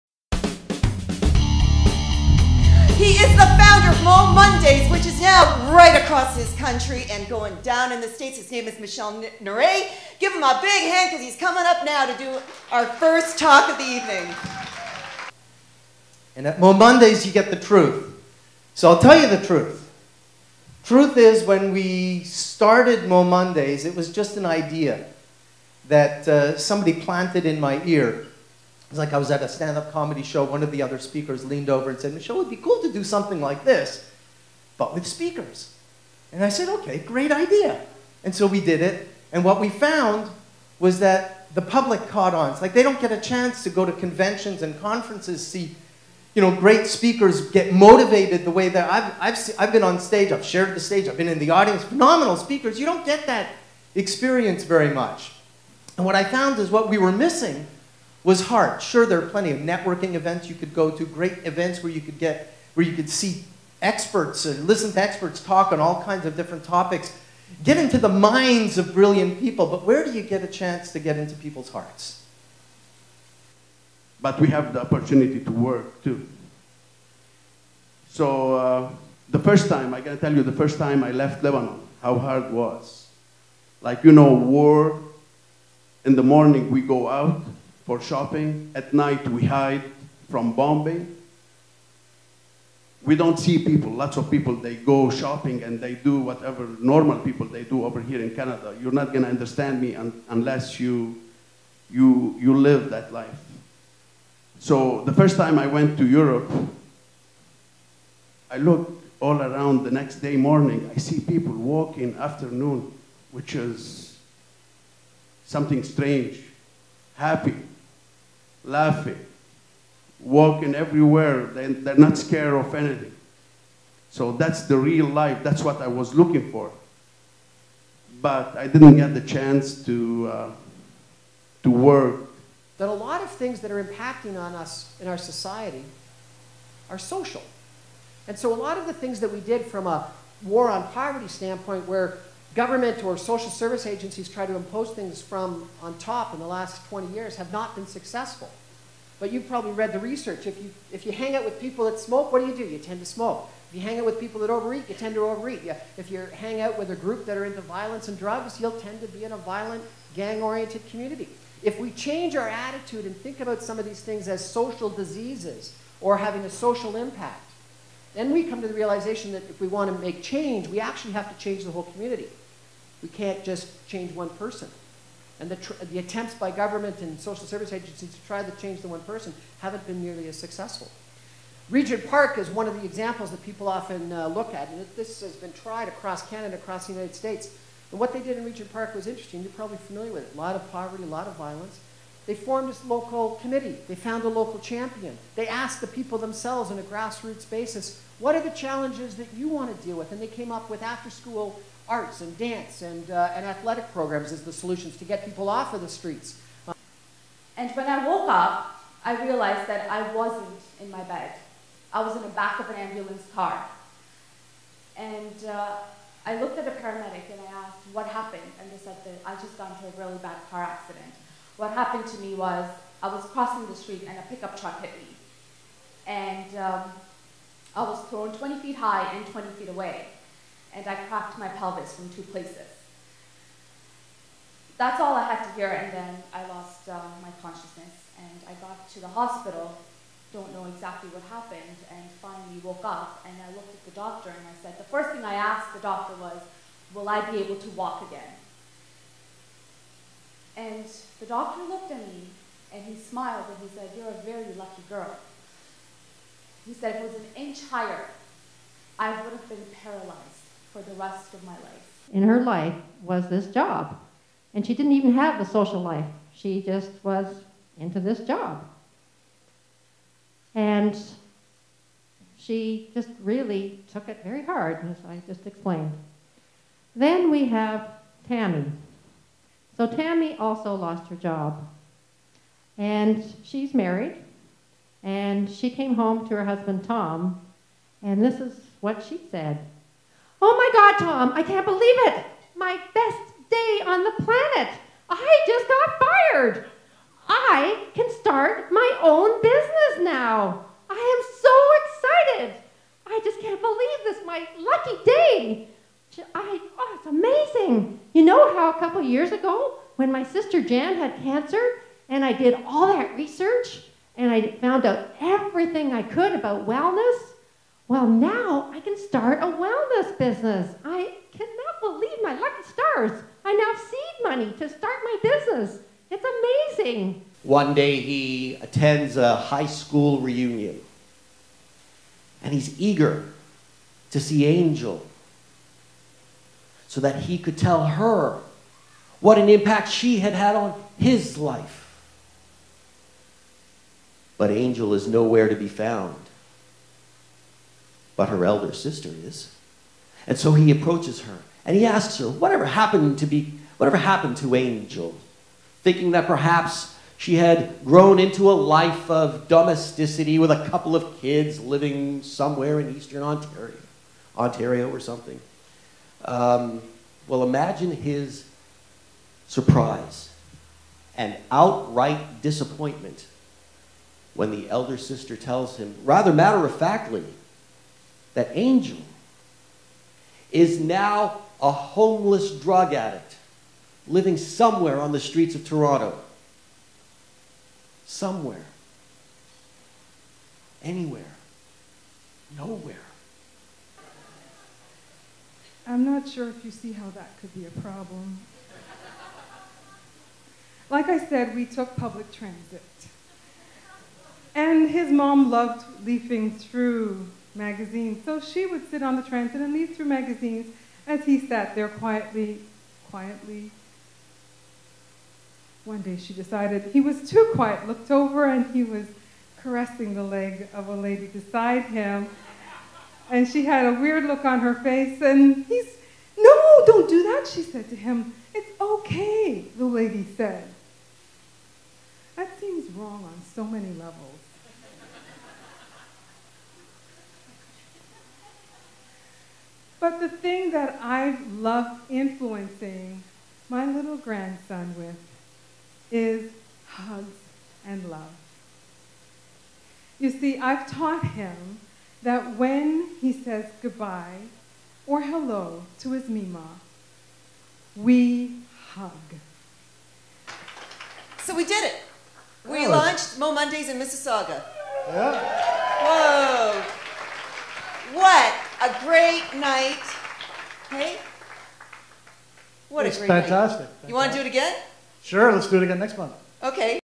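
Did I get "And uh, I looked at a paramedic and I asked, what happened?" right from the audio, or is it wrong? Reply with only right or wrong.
right.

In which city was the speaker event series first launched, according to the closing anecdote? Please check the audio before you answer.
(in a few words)
Mississauga.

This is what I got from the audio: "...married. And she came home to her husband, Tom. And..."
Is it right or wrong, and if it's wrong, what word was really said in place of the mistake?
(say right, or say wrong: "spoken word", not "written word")
right.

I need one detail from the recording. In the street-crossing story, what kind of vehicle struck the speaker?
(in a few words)
Pickup truck.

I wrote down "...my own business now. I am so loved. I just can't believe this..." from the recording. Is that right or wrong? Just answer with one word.
wrong.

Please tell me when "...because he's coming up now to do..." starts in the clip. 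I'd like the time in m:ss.
0:11.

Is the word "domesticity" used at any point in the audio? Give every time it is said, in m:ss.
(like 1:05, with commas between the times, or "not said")
5:59.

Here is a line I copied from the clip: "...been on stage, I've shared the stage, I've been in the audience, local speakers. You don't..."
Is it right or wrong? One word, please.
wrong.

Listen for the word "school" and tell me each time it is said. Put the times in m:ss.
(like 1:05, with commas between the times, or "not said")
3:21, 5:29.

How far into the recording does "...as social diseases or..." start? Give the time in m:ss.
2:44.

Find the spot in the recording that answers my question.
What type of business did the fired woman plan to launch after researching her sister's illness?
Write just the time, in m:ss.
5:19.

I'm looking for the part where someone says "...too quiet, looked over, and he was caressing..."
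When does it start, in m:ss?
6:57.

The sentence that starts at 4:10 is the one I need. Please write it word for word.
And the doctor looked at me, and he smiled, and he said, you're a very lucky girl.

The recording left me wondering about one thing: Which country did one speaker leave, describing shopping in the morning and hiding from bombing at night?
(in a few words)
Lebanon.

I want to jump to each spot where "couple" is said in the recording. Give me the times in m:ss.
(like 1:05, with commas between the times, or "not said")
5:08, 6:00.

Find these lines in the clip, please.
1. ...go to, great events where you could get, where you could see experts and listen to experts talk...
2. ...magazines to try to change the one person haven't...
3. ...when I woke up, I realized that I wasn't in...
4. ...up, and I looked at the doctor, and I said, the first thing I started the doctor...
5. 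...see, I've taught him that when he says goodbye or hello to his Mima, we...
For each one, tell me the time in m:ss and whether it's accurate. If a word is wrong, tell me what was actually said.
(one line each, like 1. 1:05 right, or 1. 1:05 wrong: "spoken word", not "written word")
1. 1:00 right
2. 2:57 wrong: "agencies", not "magazines"
3. 3:27 right
4. 4:02 wrong: "asked", not "started"
5. 7:30 right.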